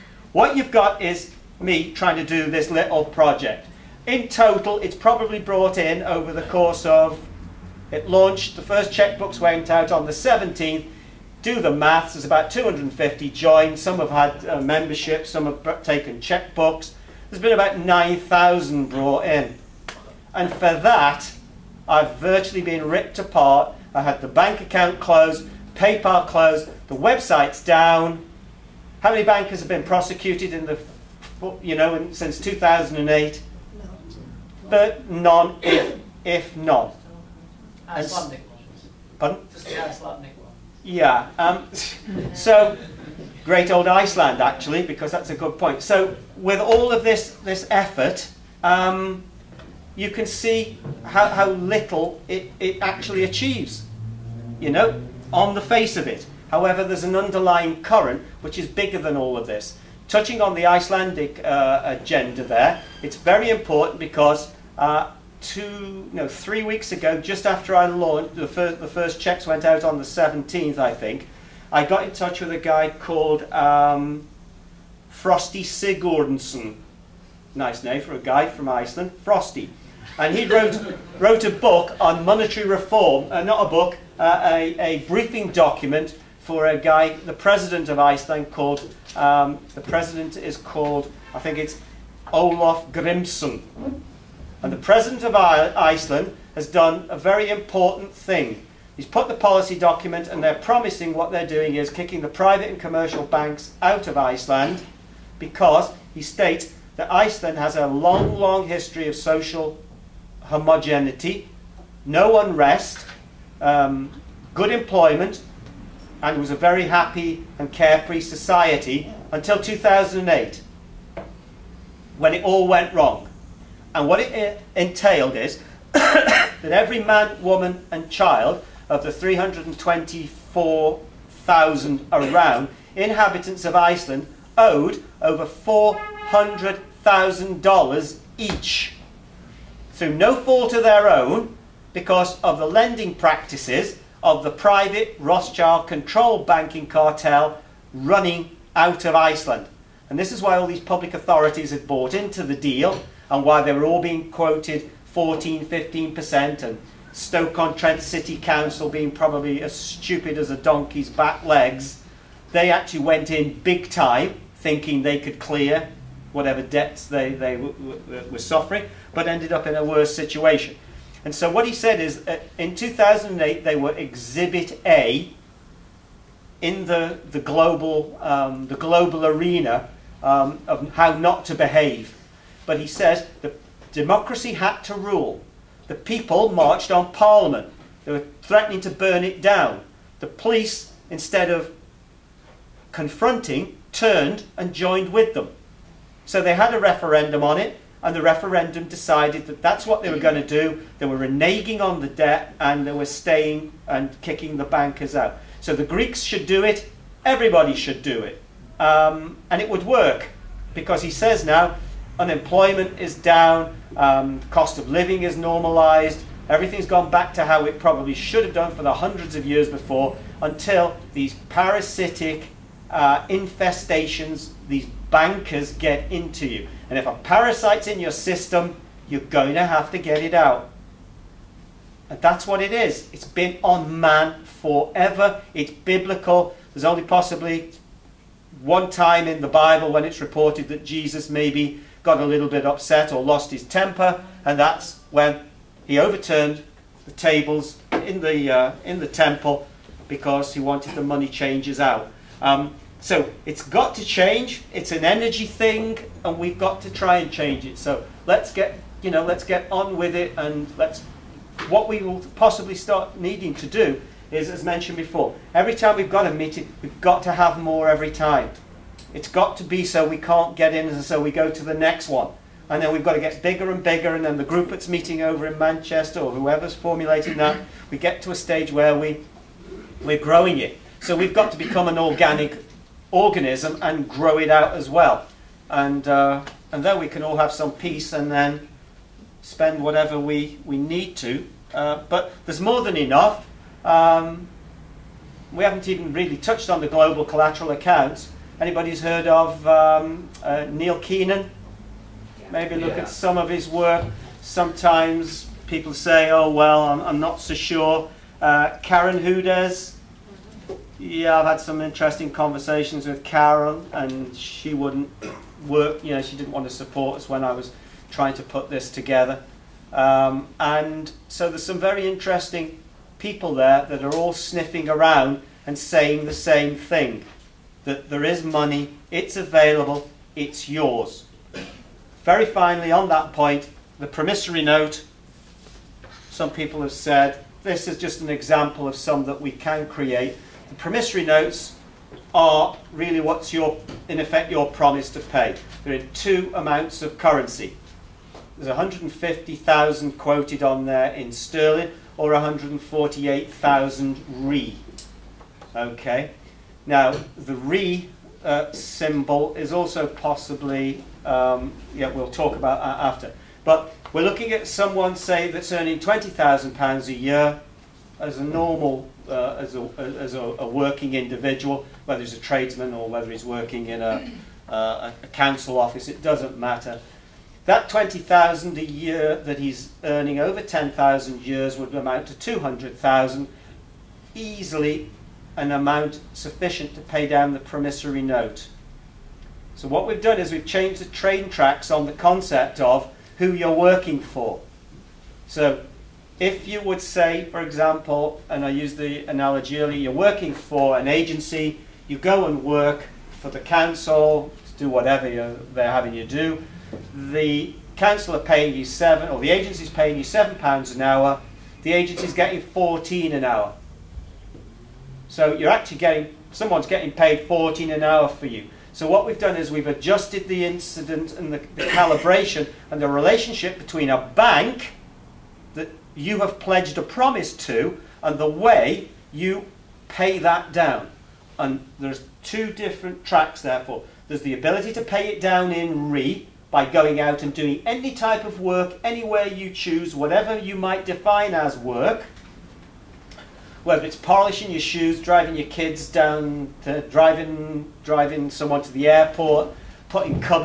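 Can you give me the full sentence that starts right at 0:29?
How many bankers have been prosecuted in the, you know, since 2008?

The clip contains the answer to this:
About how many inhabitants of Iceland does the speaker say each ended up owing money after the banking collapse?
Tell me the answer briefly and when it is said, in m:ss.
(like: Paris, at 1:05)
324,000, at 2:09.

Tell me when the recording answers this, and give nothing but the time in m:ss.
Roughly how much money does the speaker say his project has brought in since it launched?
0:17.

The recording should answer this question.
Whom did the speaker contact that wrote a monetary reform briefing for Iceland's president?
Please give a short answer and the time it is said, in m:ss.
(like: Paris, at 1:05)
Frosti Sigurdsson, at 1:15.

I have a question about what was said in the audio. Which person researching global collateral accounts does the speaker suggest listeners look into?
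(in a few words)
Neil Keenan.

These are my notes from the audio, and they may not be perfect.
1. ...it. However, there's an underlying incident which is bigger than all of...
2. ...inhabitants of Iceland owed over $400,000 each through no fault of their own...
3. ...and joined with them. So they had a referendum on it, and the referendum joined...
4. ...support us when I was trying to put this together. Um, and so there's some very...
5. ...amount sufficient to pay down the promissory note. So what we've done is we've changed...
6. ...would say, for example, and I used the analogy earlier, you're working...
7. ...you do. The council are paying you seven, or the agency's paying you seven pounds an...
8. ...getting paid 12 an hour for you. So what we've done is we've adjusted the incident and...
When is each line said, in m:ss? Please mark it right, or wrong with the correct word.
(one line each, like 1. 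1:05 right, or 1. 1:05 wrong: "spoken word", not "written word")
1. 0:56 wrong: "current", not "incident"
2. 2:12 right
3. 3:14 wrong: "decided", not "joined"
4. 5:16 right
5. 6:25 right
6. 6:36 right
7. 6:46 right
8. 6:56 wrong: "14", not "12".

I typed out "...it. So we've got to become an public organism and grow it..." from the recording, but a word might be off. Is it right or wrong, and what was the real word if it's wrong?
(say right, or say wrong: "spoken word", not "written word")
wrong: "organic", not "public".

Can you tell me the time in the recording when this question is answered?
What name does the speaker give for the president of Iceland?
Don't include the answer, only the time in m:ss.
1:32.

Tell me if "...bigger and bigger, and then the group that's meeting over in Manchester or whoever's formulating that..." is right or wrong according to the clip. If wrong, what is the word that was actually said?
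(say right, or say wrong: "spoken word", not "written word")
right.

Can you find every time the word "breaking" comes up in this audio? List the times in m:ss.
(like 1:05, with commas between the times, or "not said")
not said.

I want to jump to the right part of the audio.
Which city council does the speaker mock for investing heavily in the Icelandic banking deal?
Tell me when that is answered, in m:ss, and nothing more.
2:37.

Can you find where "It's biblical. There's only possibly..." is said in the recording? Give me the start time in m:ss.
3:55.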